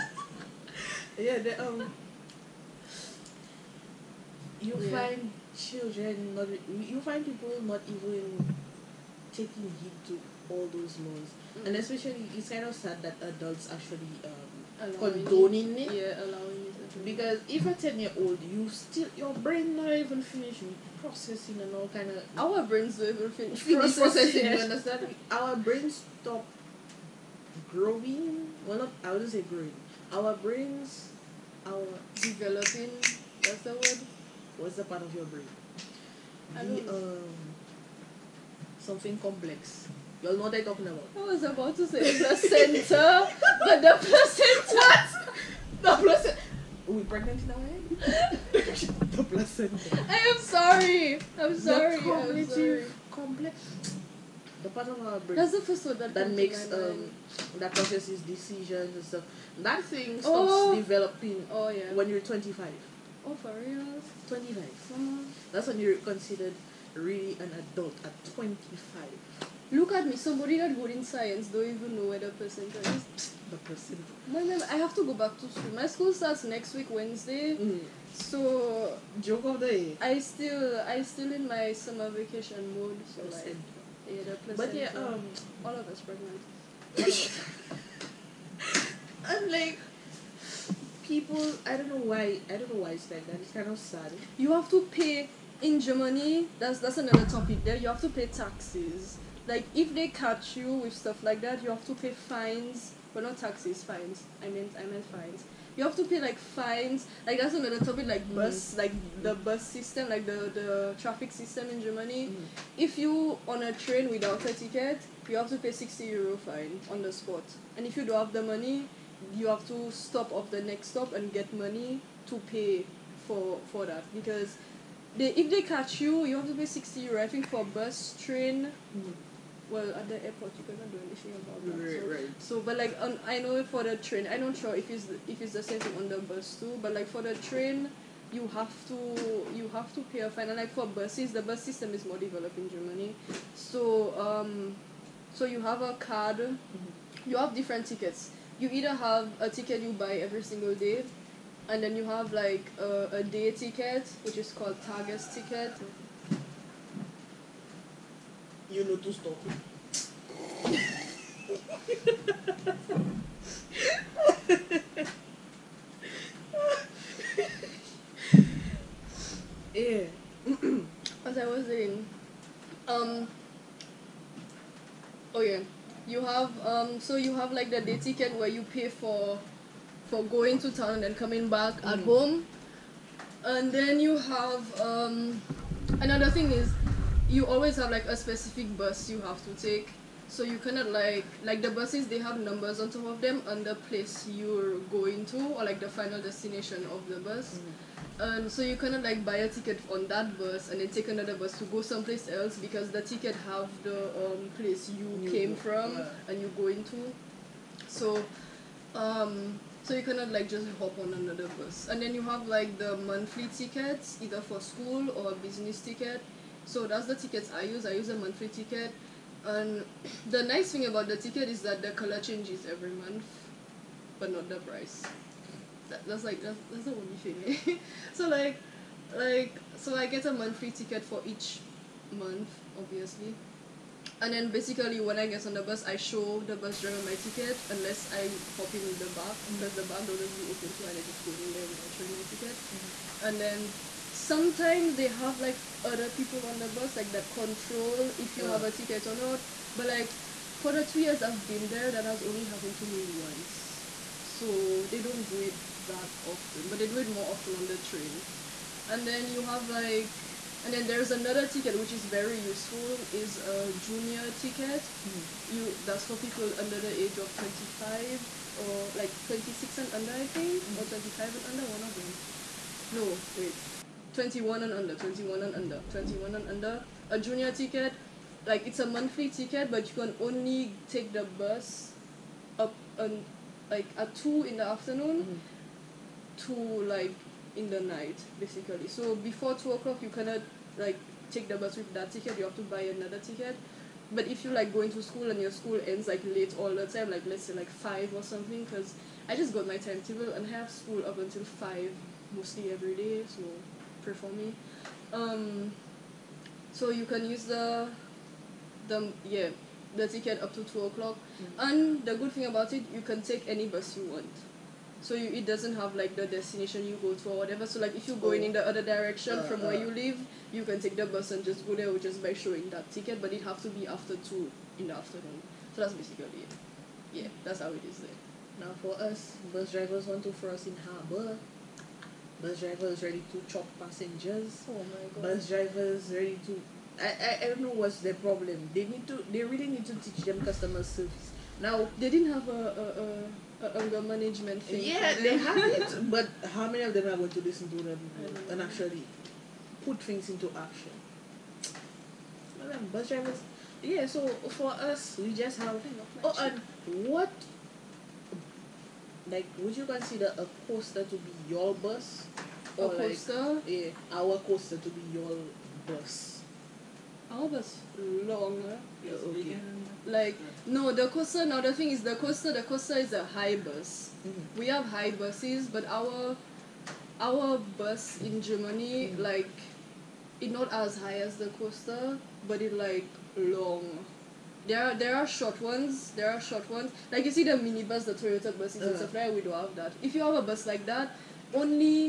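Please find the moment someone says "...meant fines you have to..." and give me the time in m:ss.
1:44.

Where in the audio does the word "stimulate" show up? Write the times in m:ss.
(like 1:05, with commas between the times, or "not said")
not said.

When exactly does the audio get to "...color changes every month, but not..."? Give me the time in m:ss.
3:41.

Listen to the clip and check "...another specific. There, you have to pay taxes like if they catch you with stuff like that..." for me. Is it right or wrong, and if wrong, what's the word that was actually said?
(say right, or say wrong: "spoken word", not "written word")
wrong: "topic", not "specific".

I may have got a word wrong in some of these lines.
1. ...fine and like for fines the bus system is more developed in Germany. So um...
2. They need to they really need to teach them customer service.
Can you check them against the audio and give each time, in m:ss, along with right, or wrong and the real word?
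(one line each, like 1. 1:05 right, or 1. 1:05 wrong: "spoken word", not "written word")
1. 2:20 wrong: "buses", not "fines"
2. 5:38 right.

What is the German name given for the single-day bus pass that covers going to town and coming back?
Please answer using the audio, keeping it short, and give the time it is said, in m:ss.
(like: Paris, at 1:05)
Tages ticket, at 2:34.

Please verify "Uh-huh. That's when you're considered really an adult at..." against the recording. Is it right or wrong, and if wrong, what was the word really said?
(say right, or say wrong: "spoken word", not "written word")
right.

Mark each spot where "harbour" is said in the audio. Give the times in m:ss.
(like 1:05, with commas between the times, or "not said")
5:30.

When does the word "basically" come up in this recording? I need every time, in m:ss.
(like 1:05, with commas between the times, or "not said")
3:54, 4:48, 5:25.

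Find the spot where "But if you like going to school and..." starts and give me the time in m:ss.
4:54.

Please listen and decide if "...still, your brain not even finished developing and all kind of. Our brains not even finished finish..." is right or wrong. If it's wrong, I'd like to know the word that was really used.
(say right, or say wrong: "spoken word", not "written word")
wrong: "processing", not "developing".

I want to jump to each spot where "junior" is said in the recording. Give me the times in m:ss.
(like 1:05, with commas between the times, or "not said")
4:23, 4:37.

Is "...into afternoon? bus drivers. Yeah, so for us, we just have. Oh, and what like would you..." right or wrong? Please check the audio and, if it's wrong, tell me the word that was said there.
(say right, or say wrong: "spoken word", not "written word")
wrong: "action", not "afternoon".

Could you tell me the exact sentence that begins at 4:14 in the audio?
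So they don't do it that often, but they do it more often on the train.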